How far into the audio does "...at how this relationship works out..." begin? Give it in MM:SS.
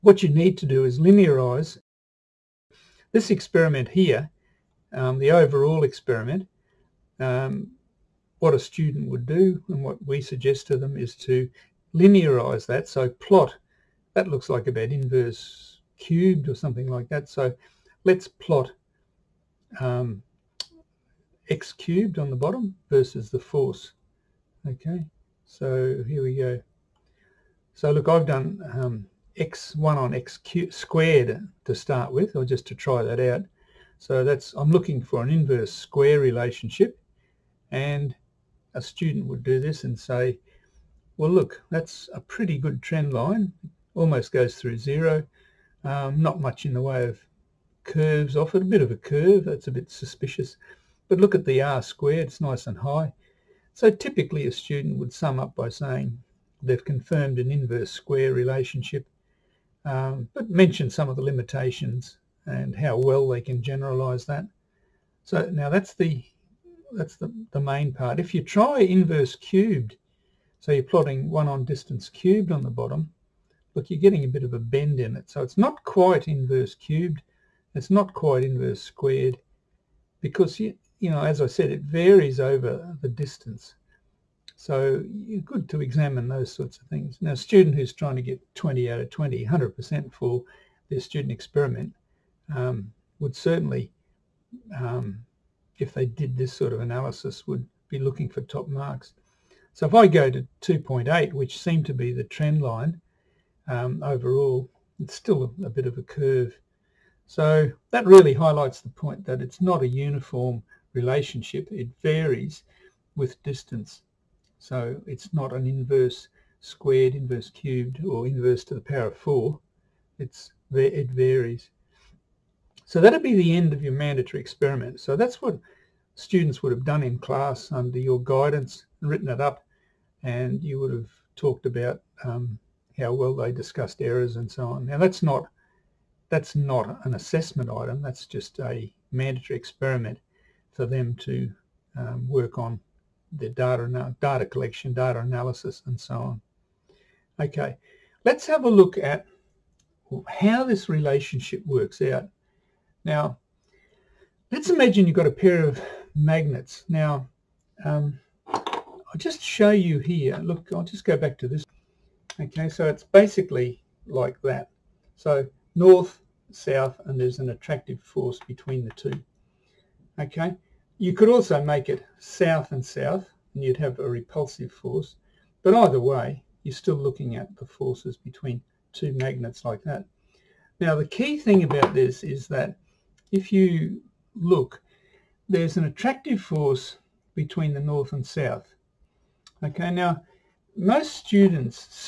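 02:28.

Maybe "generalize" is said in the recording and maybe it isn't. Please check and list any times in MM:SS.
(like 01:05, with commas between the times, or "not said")
01:03.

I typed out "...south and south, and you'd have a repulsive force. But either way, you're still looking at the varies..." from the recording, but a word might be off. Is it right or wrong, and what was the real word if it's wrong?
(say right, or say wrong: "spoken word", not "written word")
wrong: "forces", not "varies".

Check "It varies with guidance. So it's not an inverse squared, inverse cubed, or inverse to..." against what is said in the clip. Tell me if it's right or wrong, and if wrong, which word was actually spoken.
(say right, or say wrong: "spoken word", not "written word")
wrong: "distance", not "guidance".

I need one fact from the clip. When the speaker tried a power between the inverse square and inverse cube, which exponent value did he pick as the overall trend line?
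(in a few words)
2.8.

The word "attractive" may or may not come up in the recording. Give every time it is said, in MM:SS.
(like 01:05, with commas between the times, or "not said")
02:47, 03:05.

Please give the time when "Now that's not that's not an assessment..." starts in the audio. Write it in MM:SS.
02:14.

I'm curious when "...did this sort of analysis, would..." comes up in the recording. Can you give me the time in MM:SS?
01:36.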